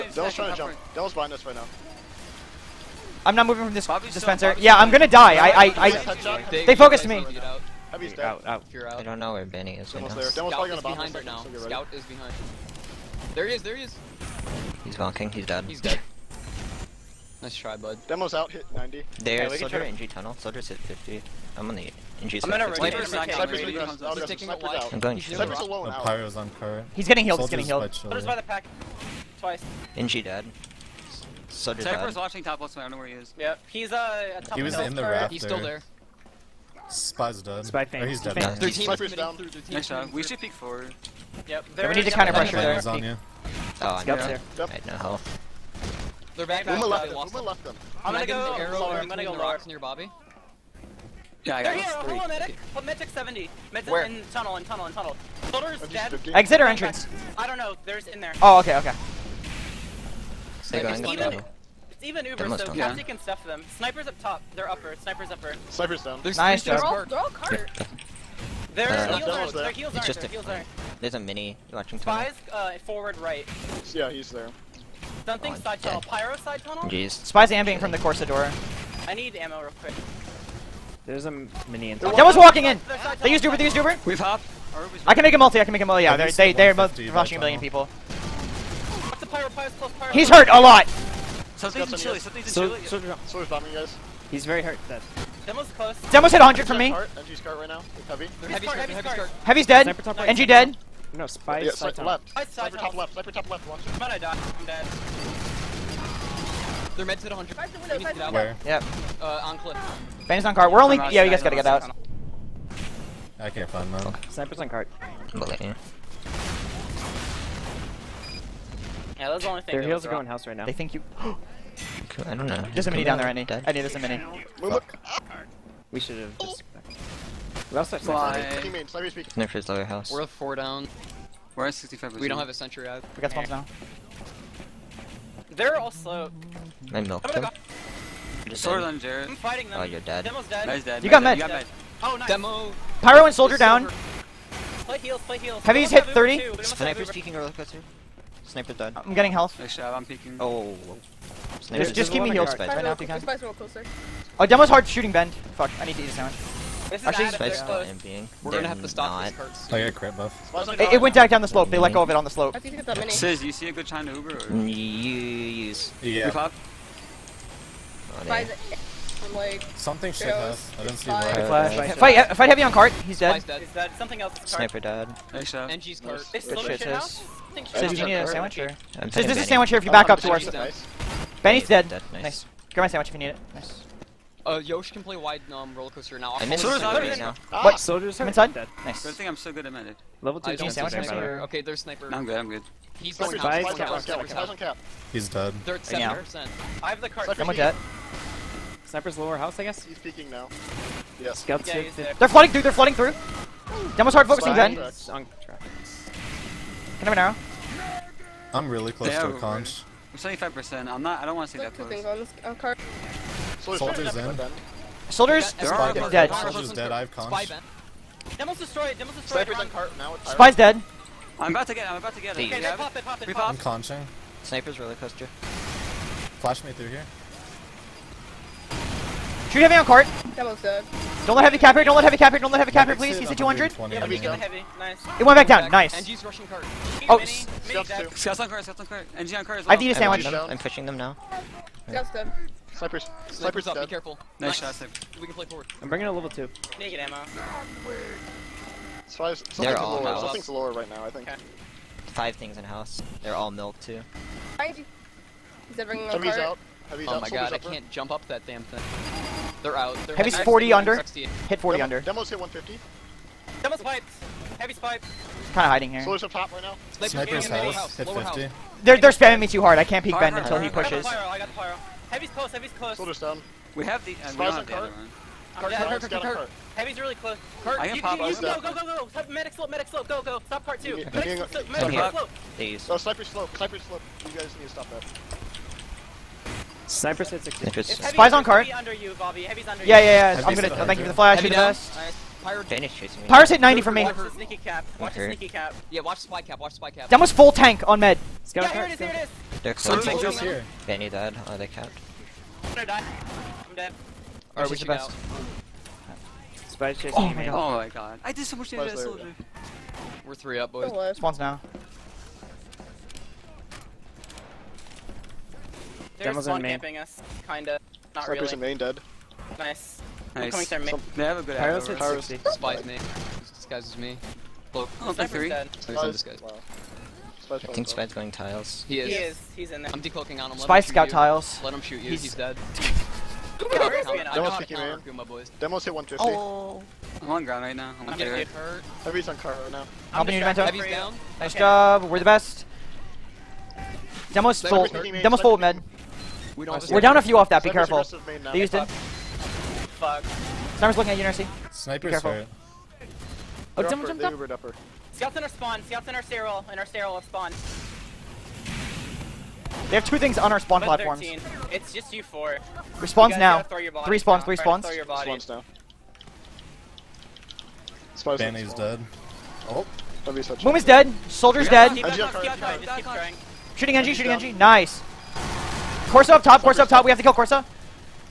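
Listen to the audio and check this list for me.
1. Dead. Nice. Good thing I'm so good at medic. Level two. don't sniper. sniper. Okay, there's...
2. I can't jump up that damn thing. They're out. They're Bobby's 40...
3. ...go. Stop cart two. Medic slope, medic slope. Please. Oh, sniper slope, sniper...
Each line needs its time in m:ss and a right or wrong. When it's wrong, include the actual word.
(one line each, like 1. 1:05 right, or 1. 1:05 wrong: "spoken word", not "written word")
1. 3:08 right
2. 4:17 wrong: "Heavy", not "Bobby"
3. 4:40 right.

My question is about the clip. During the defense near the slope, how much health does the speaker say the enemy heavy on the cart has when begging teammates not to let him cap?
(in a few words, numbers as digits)
200.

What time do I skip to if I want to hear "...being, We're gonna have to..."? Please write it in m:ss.
2:38.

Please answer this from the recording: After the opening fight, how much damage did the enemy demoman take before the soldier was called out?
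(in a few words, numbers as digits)
90.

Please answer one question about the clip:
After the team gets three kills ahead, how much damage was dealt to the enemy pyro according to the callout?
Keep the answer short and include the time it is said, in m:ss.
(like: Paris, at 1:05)
60, at 5:21.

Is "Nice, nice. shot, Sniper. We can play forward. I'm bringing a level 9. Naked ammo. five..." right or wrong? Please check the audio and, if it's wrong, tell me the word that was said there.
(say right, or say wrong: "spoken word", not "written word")
wrong: "2", not "9".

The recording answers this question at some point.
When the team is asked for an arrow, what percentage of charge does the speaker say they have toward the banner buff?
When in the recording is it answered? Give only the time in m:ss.
3:30.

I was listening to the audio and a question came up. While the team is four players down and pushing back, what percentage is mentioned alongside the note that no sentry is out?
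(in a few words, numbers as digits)
65.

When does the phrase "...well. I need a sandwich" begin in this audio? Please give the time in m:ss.
3:59.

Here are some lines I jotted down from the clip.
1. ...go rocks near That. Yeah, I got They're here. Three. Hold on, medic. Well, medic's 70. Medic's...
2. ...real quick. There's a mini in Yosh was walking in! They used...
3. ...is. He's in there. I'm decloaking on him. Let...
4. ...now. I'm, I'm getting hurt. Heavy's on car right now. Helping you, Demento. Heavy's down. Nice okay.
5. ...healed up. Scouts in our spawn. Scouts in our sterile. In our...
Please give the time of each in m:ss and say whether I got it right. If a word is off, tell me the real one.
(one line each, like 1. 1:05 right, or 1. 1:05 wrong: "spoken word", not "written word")
1. 0:49 wrong: "Bobby", not "That"
2. 1:19 wrong: "That", not "Yosh"
3. 5:29 right
4. 5:37 right
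5. 5:54 wrong: "jumped", not "healed".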